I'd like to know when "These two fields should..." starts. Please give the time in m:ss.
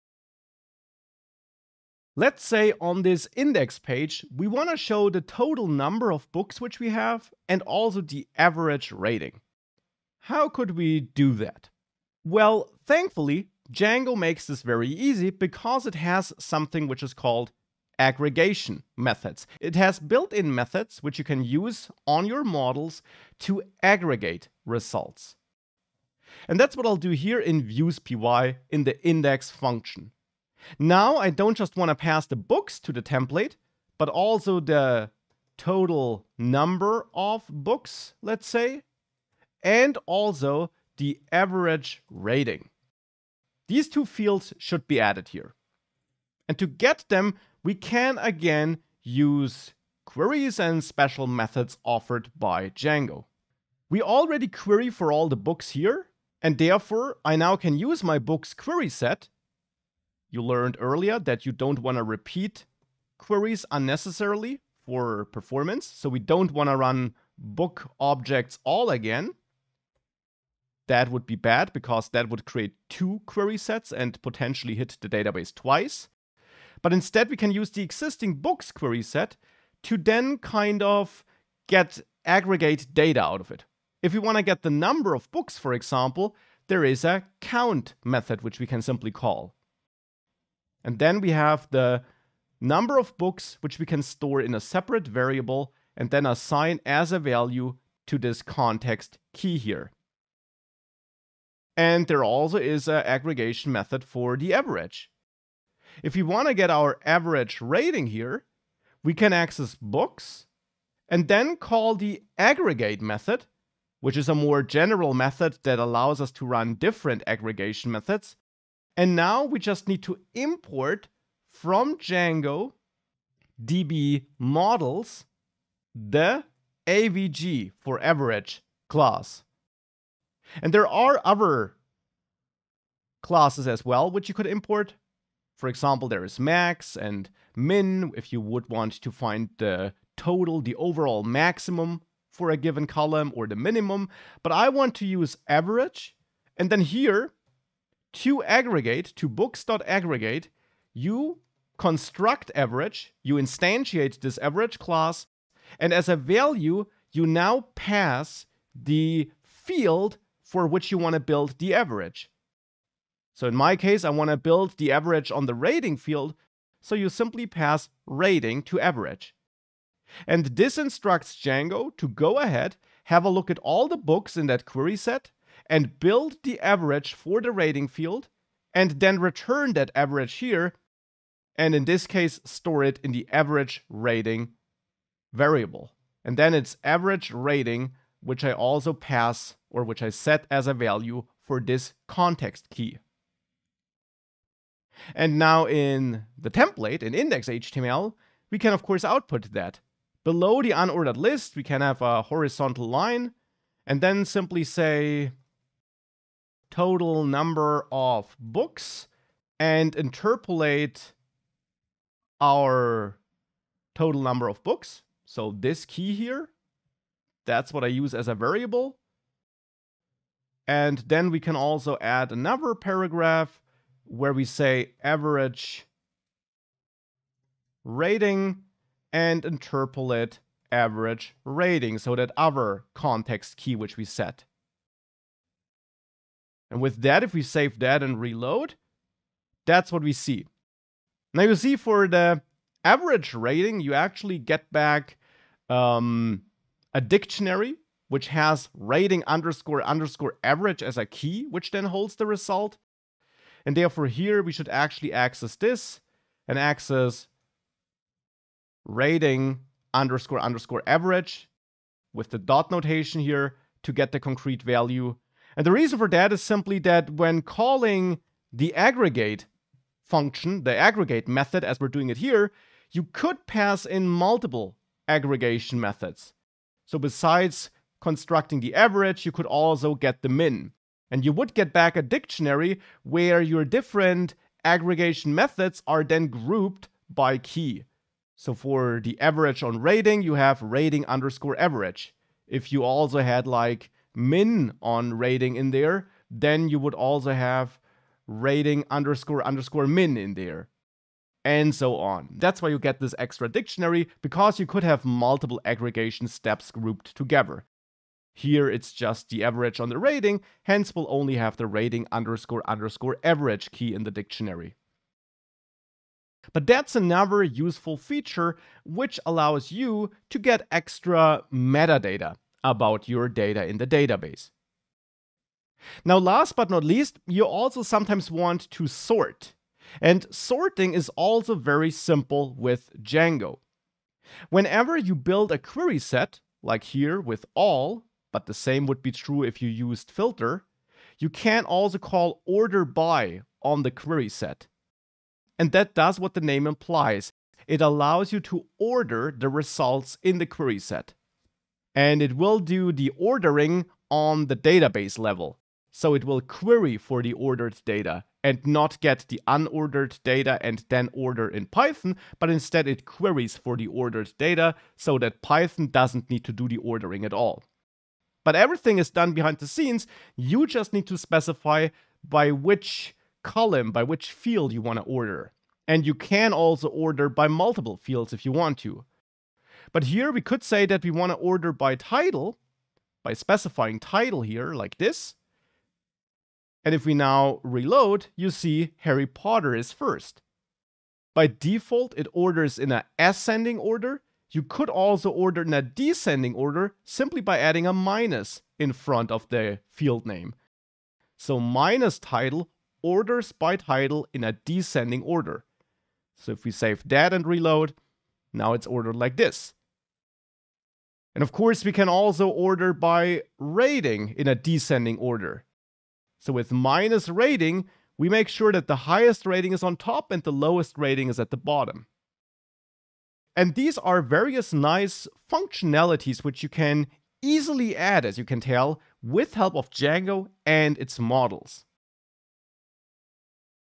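0:43.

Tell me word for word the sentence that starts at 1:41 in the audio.
And there also is an aggregation method for the average.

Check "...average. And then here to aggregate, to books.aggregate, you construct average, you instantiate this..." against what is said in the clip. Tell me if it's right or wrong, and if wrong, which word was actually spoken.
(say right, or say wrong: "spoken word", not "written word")
right.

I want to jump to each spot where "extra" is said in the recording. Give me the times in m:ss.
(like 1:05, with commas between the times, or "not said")
5:03, 5:20.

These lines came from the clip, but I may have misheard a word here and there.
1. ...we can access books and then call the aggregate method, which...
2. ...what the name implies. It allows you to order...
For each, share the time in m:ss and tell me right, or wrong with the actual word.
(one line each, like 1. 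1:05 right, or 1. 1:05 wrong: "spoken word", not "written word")
1. 1:49 right
2. 5:46 right.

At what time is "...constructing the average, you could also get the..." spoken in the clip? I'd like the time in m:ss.
4:38.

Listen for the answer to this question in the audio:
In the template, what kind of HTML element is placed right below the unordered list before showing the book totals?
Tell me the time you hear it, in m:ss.
3:22.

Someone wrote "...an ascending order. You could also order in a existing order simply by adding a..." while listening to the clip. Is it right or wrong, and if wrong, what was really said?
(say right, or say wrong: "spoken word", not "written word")
wrong: "descending", not "existing".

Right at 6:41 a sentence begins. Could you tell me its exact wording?
So minus title orders by title in a descending order.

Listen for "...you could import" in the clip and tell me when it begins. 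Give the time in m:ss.
2:14.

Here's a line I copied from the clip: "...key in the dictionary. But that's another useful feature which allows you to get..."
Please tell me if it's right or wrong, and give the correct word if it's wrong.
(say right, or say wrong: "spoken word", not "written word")
right.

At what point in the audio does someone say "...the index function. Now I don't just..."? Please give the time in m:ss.
0:28.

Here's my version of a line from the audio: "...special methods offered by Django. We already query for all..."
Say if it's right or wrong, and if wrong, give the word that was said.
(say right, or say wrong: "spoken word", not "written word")
right.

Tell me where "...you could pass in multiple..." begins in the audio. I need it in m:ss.
4:32.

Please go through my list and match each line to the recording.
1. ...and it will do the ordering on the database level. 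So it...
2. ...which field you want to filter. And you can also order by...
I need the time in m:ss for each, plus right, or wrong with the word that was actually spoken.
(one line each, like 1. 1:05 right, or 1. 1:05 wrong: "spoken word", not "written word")
1. 5:51 right
2. 6:14 wrong: "order", not "filter".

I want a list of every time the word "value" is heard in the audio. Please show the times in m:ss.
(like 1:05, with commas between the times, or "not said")
1:37, 2:36, 3:10, 4:24.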